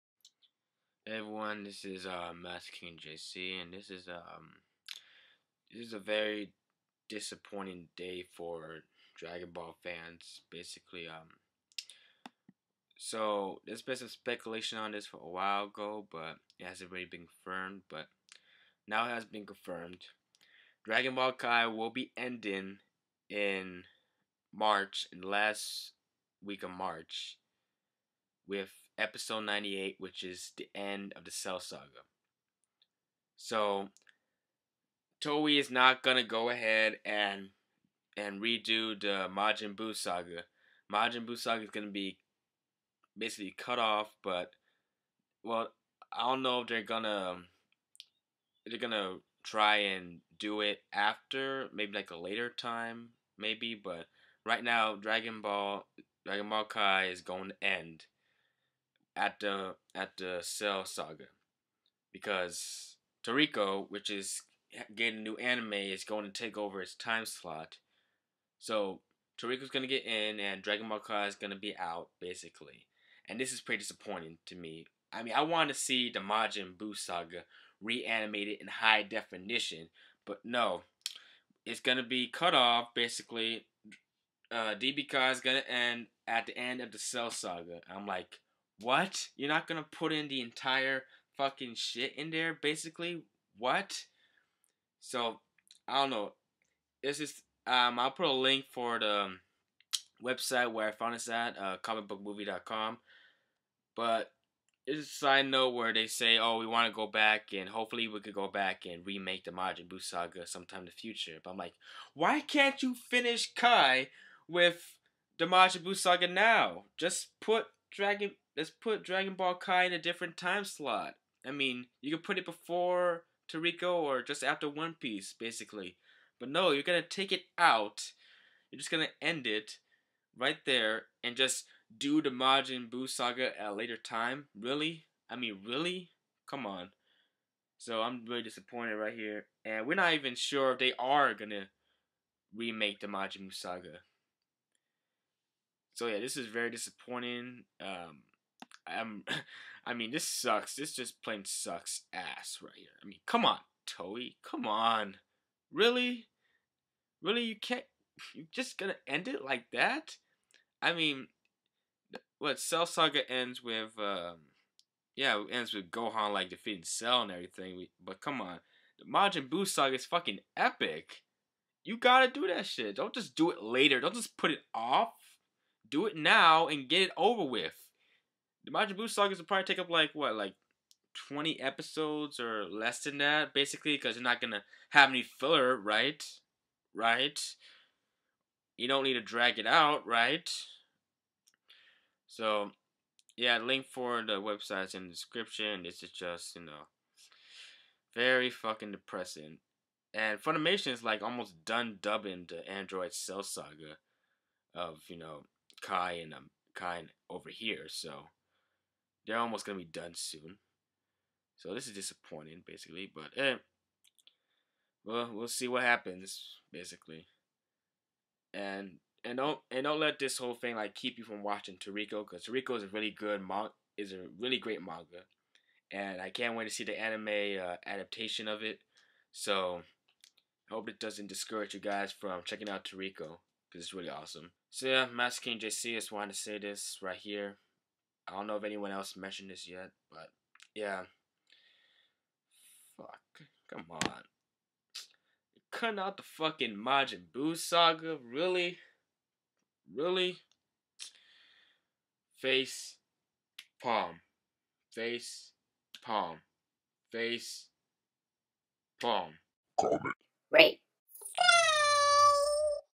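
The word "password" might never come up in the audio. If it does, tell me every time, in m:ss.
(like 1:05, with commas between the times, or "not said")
not said.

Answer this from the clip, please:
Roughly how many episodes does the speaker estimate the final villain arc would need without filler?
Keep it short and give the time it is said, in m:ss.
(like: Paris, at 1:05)
20, at 3:01.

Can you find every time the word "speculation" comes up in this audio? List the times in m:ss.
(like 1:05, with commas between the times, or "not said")
0:14.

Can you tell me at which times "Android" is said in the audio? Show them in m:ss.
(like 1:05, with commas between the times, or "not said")
3:22.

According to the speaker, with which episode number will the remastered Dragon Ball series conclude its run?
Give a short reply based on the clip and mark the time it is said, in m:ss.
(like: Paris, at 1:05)
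98, at 0:29.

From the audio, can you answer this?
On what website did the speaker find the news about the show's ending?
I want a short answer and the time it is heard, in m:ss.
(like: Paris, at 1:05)
comicbookmovie.com, at 1:41.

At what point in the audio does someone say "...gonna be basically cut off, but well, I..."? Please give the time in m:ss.
0:41.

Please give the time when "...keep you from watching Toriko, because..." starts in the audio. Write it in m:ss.
3:40.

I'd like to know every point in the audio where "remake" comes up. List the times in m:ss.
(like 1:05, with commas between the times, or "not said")
1:49, 2:22.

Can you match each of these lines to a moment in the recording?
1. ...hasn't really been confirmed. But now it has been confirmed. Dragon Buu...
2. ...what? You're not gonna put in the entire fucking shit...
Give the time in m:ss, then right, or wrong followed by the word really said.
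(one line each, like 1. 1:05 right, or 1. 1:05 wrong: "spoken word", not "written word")
1. 0:16 wrong: "Ball", not "Buu"
2. 1:28 right.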